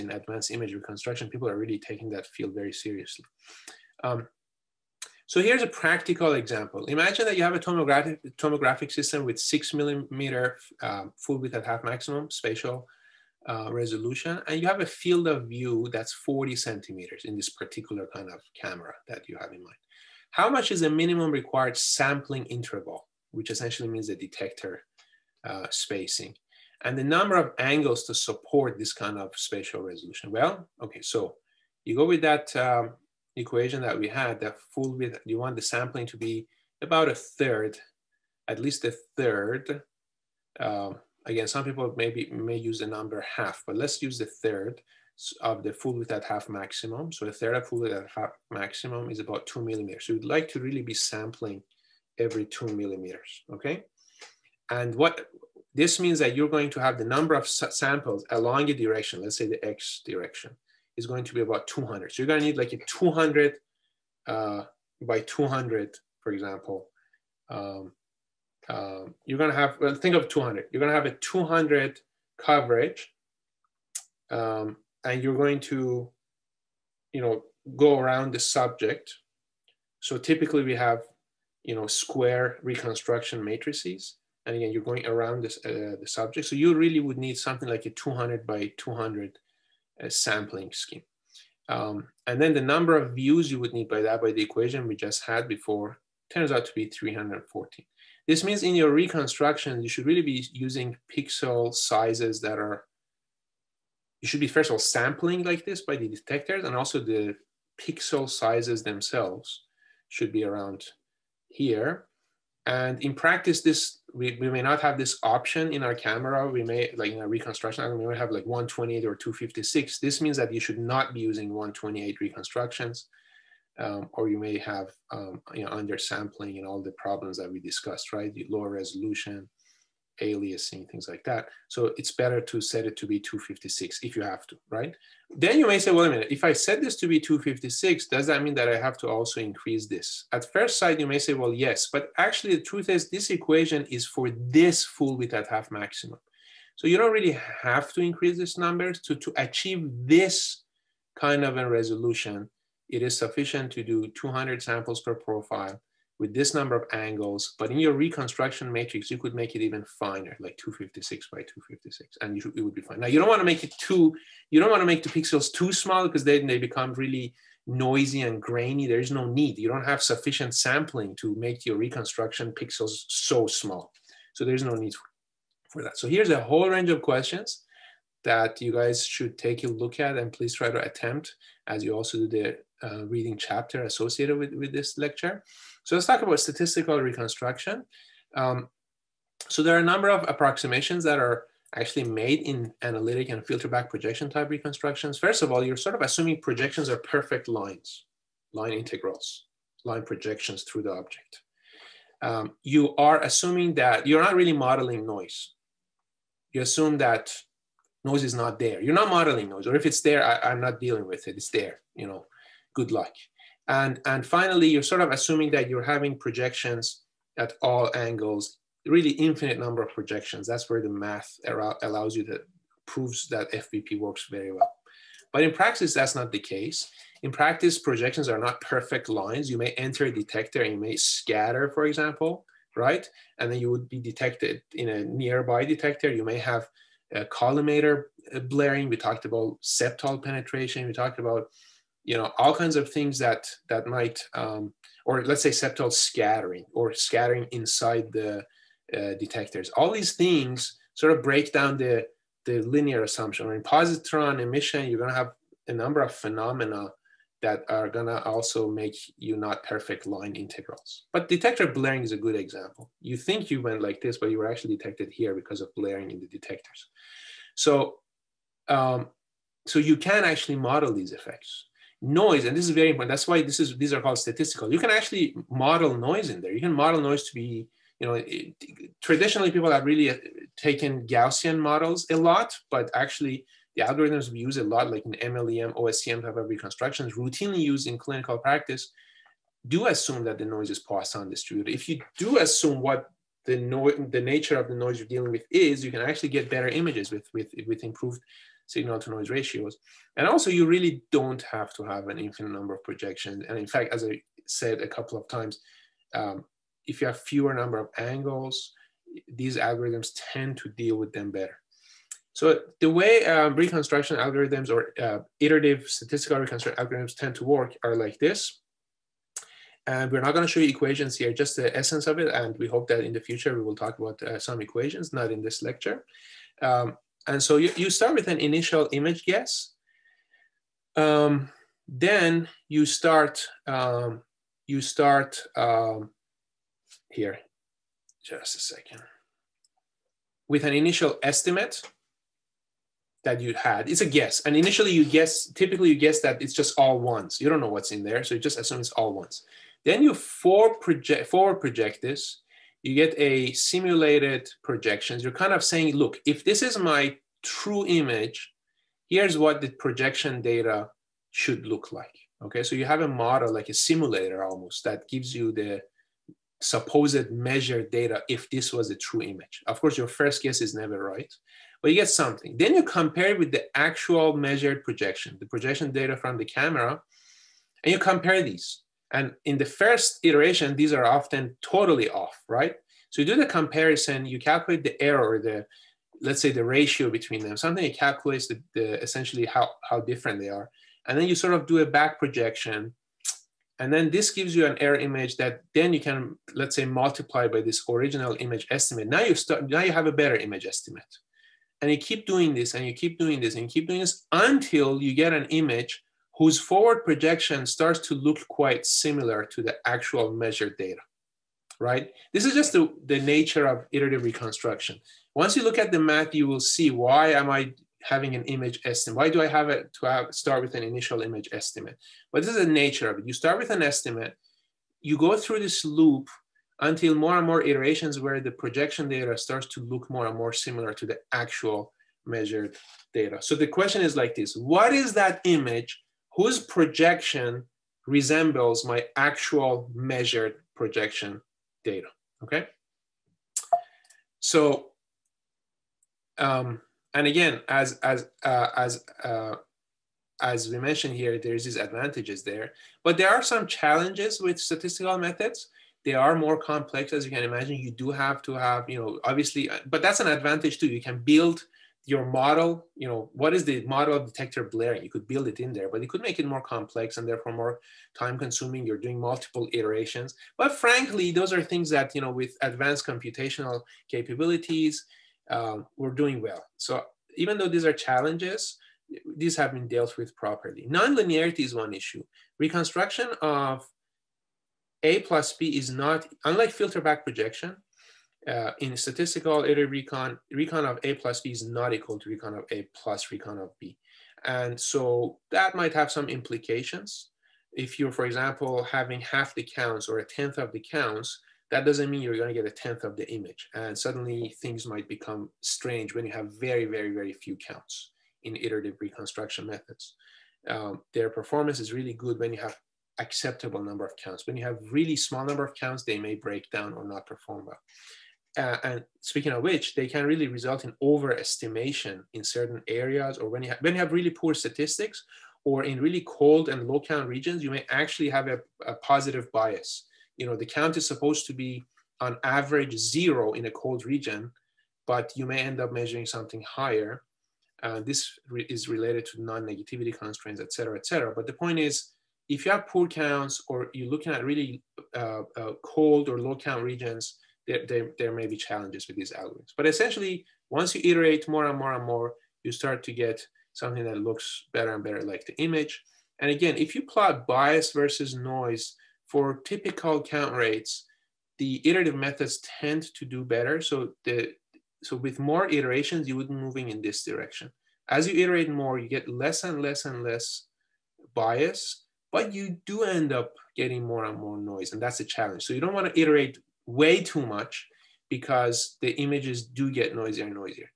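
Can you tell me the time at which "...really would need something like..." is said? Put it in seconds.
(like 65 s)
86 s.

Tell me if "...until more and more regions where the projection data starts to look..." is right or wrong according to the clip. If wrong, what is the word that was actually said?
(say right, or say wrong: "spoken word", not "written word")
wrong: "iterations", not "regions".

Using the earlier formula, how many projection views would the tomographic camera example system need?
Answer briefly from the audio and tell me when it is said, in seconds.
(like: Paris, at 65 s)
314, at 96 s.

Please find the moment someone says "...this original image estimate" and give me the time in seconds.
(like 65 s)
397 s.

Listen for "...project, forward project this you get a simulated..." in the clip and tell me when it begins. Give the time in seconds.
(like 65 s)
350 s.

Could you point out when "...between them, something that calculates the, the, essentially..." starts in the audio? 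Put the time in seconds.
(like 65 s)
387 s.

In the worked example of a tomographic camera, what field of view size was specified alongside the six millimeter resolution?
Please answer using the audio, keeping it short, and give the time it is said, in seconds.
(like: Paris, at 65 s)
40 centimeters, at 16 s.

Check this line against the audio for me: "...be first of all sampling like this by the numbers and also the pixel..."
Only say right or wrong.
wrong.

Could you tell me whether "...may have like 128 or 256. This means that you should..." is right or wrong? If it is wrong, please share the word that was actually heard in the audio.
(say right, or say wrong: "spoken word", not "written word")
right.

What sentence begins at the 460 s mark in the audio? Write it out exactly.
You can build your model, you know, what is the model of detector blurring?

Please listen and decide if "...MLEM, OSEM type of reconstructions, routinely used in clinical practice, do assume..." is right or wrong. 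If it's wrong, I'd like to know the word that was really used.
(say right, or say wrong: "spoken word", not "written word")
right.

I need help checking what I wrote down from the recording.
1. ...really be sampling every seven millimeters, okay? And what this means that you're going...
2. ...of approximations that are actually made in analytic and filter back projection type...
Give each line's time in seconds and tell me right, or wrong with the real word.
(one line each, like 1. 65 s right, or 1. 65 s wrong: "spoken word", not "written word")
1. 50 s wrong: "two", not "seven"
2. 190 s right.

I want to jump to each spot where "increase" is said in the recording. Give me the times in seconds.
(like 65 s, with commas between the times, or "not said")
139 s, 147 s.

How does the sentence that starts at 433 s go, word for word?
So the question is like this, what is that image whose projection resembles my actual measured projection data, okay?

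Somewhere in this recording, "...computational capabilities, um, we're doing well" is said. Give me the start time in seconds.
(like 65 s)
473 s.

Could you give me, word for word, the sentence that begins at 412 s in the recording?
This is just the, the nature of iterative reconstruction.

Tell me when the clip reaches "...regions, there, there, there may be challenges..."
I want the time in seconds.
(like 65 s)
546 s.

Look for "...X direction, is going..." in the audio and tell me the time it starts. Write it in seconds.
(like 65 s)
59 s.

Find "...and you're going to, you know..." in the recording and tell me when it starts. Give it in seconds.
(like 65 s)
75 s.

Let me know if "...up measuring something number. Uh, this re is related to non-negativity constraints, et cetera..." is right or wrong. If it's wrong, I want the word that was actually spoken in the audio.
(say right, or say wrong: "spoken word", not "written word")
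wrong: "higher", not "number".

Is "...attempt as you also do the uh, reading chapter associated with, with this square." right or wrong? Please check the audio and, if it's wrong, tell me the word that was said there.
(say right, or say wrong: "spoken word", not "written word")
wrong: "lecture", not "square".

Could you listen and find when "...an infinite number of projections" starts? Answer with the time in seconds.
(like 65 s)
302 s.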